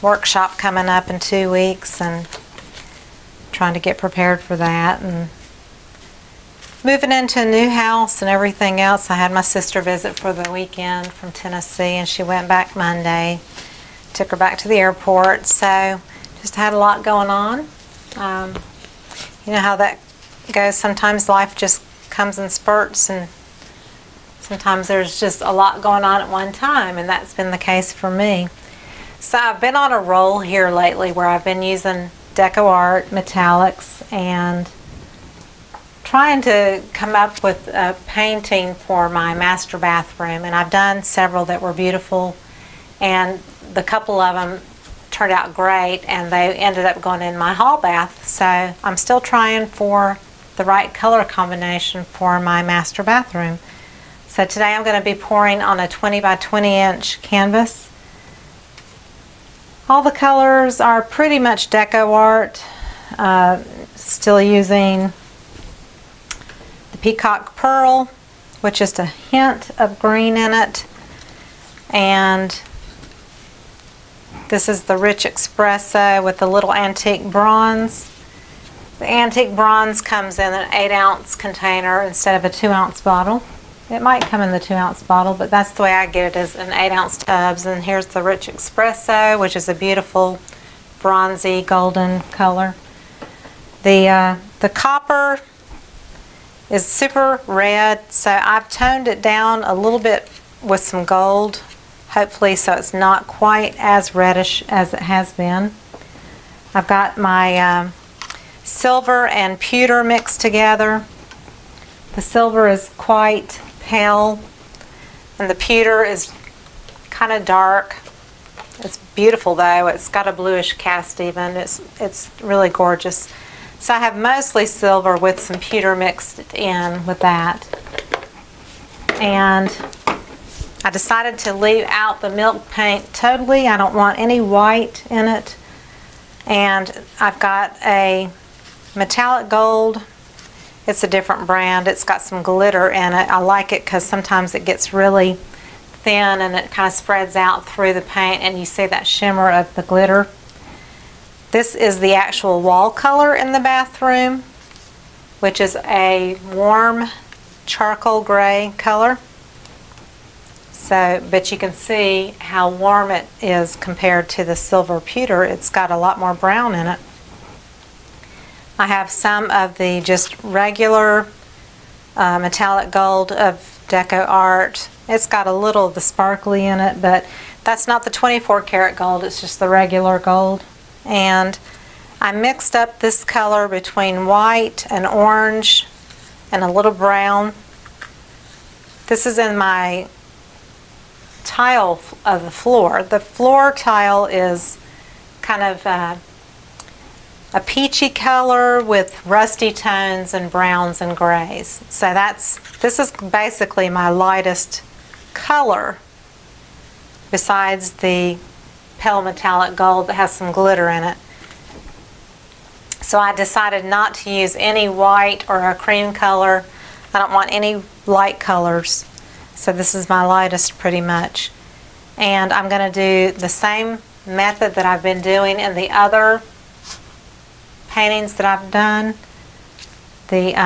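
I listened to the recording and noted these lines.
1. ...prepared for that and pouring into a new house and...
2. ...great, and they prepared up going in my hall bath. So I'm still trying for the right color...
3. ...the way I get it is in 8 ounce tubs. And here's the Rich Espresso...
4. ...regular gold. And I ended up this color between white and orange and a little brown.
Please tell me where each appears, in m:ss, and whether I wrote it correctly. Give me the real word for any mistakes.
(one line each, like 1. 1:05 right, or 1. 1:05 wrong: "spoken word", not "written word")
1. 0:03 wrong: "moving", not "pouring"
2. 0:45 wrong: "ended", not "prepared"
3. 1:25 right
4. 2:59 wrong: "mixed", not "ended".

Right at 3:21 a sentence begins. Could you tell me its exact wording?
So that's, this is basically my lightest color besides the pale metallic gold that has some glitter in it.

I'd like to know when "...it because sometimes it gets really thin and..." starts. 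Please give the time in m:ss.
2:23.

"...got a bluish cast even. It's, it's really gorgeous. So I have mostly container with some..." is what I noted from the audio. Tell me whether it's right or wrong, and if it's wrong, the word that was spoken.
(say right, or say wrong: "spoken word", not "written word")
wrong: "silver", not "container".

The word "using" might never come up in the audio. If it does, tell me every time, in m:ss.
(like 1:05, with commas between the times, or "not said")
0:31, 1:04.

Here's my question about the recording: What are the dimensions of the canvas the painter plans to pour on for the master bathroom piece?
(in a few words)
20 by 20 inch.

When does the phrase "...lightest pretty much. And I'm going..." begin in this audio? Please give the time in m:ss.
3:40.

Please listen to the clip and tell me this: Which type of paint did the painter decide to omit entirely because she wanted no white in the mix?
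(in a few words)
milk paint.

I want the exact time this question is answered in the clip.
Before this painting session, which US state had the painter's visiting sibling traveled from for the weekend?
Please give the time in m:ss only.
0:11.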